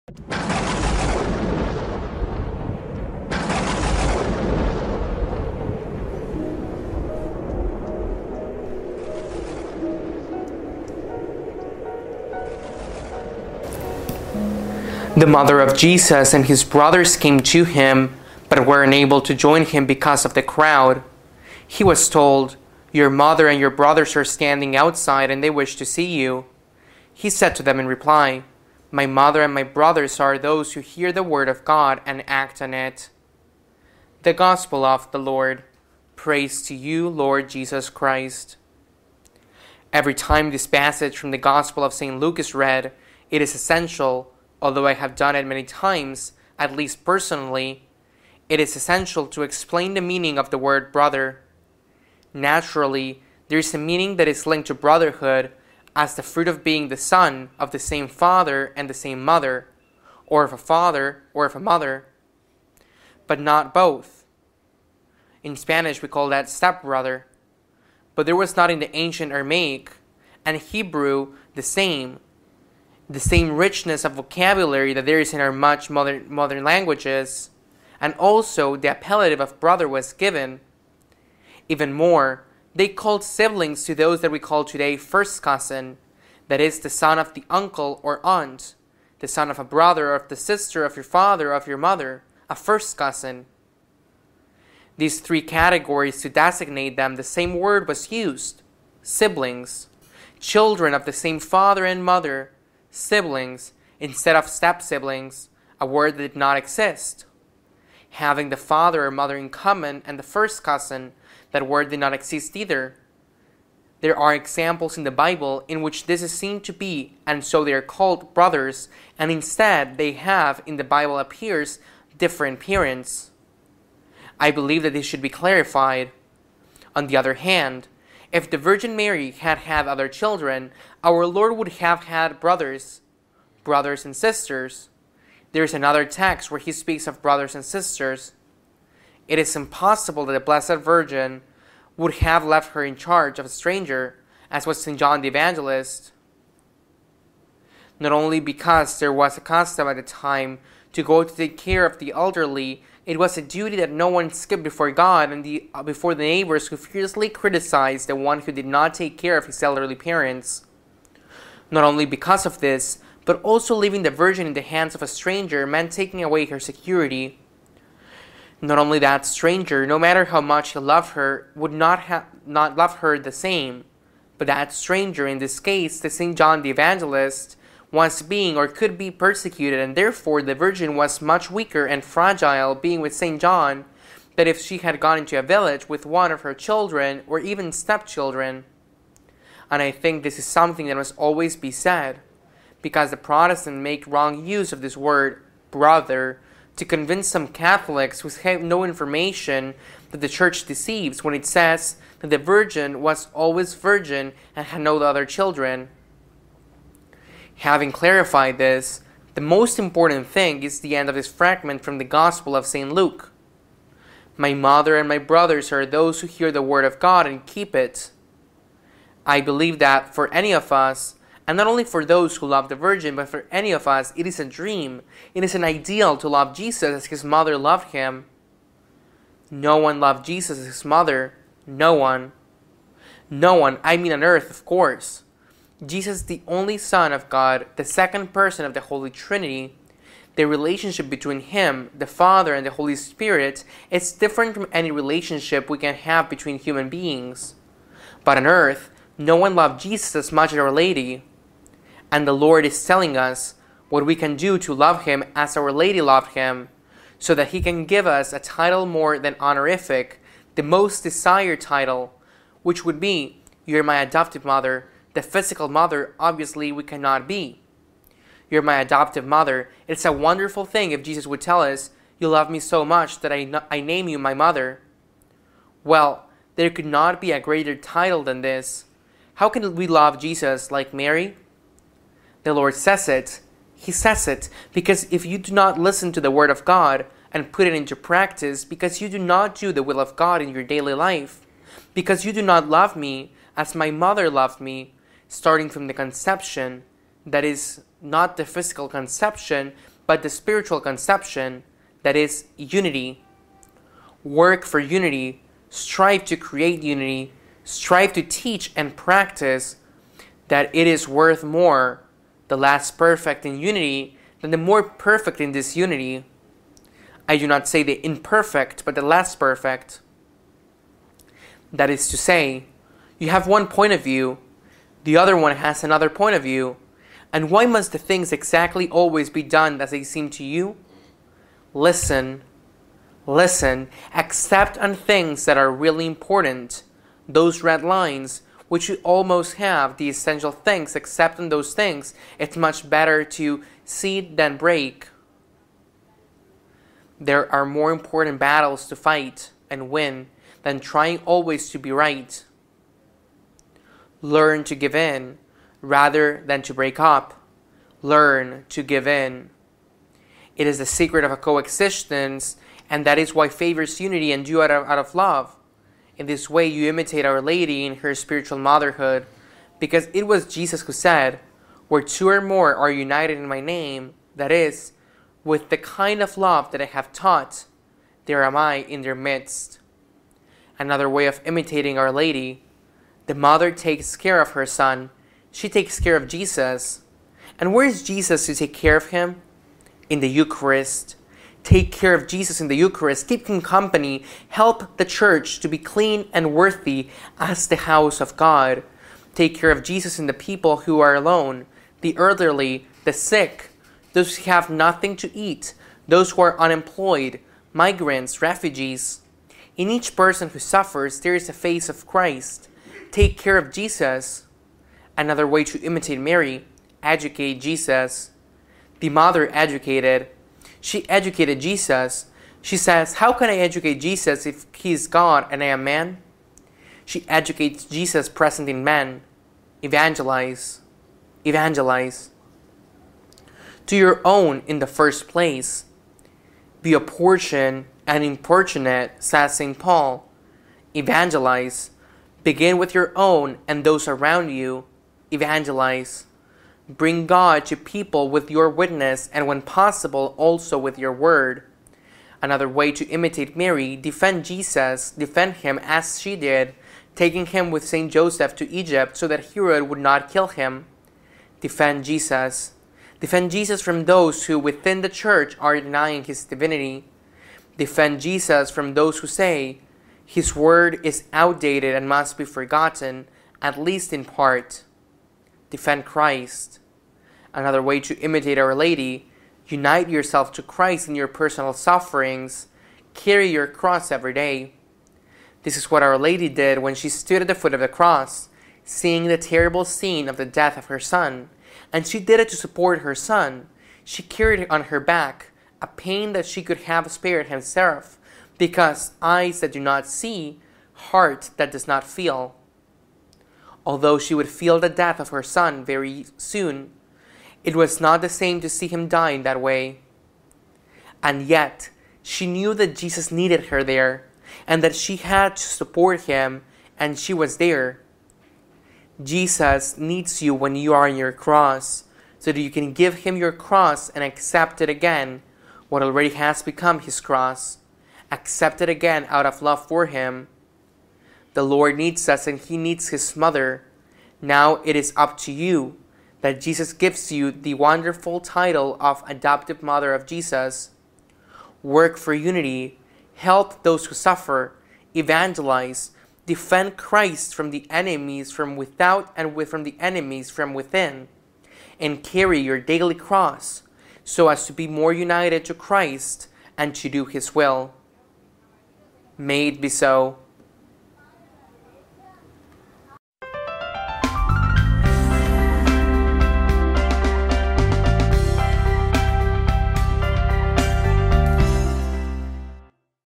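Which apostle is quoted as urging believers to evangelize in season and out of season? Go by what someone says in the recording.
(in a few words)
St. Paul.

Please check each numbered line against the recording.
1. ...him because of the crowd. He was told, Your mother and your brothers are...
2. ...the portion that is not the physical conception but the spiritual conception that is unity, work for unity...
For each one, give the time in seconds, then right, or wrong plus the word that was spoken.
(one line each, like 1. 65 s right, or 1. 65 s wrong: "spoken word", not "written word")
1. 19 s right
2. 295 s wrong: "conception", not "portion".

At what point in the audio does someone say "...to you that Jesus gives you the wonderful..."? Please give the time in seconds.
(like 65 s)
535 s.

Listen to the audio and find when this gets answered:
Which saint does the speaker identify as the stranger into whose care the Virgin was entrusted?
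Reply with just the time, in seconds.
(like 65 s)
144 s.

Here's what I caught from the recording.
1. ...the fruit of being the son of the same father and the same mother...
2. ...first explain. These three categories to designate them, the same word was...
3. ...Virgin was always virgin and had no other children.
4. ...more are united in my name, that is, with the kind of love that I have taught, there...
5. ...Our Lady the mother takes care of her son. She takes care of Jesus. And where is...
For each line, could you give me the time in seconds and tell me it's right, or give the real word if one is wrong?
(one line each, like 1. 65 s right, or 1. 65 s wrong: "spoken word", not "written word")
1. 56 s right
2. 92 s wrong: "cousin", not "explain"
3. 202 s right
4. 372 s right
5. 381 s right.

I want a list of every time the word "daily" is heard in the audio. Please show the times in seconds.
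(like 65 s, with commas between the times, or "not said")
290 s, 552 s.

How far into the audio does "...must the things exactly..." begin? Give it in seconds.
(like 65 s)
327 s.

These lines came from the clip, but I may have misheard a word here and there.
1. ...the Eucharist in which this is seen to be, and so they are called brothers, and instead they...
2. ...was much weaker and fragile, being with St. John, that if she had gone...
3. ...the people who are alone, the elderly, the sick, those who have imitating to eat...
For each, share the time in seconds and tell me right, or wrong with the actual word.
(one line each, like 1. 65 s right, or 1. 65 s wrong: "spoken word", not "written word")
1. 115 s wrong: "Bible", not "Eucharist"
2. 180 s right
3. 400 s wrong: "nothing", not "imitating".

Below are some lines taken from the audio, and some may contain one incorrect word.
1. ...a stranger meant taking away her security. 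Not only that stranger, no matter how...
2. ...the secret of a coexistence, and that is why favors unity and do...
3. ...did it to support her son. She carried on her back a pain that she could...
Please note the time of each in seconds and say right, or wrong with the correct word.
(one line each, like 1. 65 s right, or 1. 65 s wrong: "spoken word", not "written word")
1. 165 s right
2. 360 s right
3. 492 s right.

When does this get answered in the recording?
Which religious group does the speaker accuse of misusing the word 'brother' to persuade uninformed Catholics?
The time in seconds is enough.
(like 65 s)
193 s.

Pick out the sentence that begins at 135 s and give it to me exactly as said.
There is another text where he speaks of brothers and sisters.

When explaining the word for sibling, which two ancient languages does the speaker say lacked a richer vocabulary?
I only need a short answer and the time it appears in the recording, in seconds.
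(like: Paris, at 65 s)
Aramaic and Hebrew, at 69 s.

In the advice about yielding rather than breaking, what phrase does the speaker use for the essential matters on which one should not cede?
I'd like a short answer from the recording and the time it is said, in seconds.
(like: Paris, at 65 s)
red lines, at 337 s.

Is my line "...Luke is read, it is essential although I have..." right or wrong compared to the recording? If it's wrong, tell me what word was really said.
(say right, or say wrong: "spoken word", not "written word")
right.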